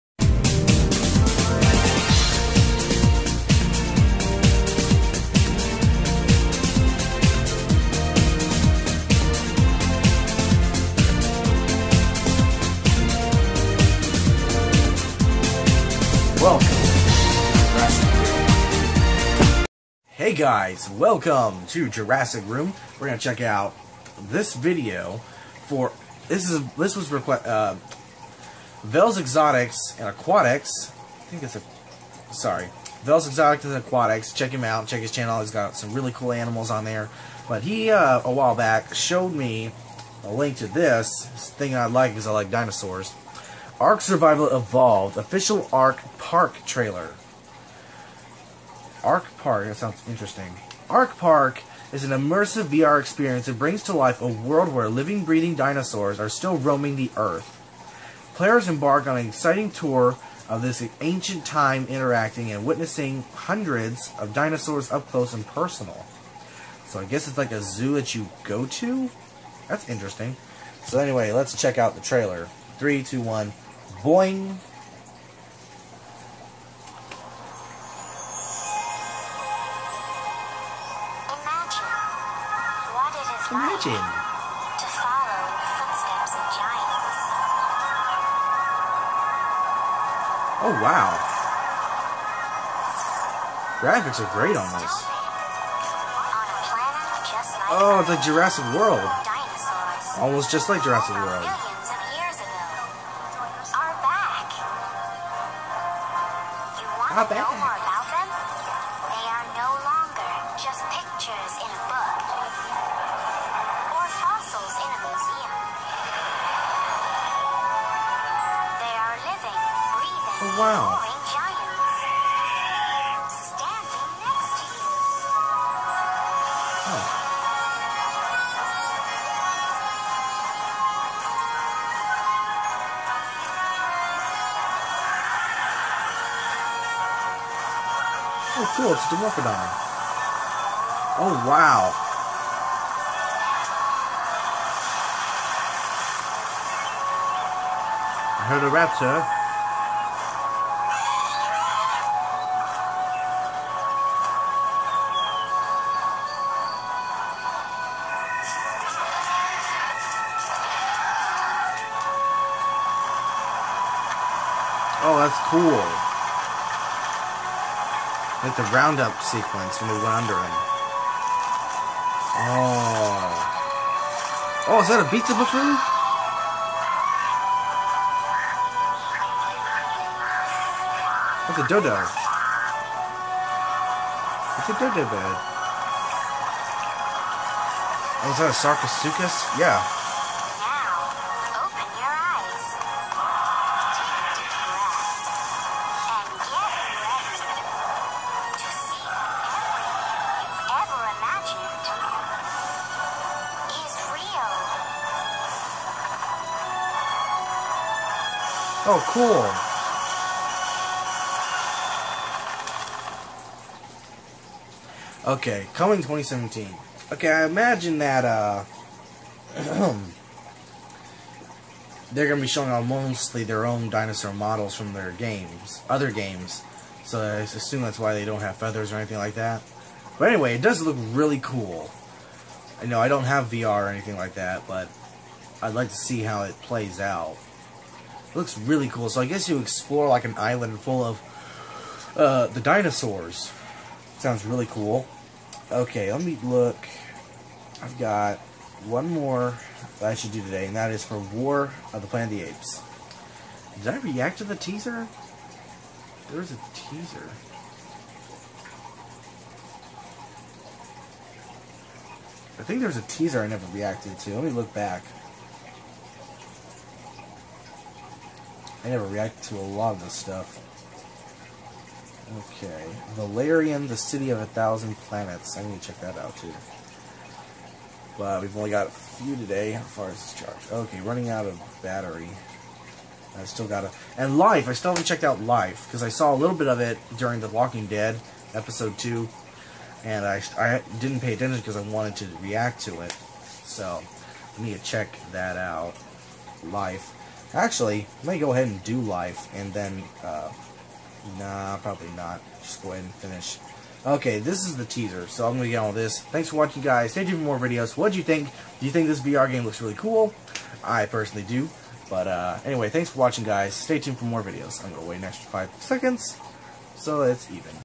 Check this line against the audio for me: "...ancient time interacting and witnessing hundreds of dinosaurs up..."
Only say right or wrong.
right.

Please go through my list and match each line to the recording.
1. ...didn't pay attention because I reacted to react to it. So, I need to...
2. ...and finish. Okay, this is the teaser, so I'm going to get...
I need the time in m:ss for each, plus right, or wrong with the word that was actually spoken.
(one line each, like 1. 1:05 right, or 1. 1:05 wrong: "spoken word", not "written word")
1. 4:50 wrong: "wanted", not "reacted"
2. 5:03 right.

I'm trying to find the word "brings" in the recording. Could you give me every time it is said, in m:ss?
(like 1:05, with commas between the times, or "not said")
0:53.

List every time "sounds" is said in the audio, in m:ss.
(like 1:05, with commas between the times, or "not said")
0:49, 4:04.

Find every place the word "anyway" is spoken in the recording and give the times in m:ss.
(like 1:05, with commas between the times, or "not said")
1:10, 3:50, 5:12.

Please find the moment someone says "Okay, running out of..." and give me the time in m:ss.
4:40.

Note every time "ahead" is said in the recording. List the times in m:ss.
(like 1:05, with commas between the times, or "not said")
4:58, 5:02.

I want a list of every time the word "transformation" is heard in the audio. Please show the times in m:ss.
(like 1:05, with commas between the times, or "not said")
not said.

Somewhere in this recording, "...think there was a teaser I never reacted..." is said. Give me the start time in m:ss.
4:22.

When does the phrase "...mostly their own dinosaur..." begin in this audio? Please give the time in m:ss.
3:42.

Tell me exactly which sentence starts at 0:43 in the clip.
Ark Survival Evolved official Ark Park trailer.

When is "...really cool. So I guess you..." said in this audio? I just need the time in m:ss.
3:58.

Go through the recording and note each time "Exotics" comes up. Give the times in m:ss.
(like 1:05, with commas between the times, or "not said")
0:29, 0:33.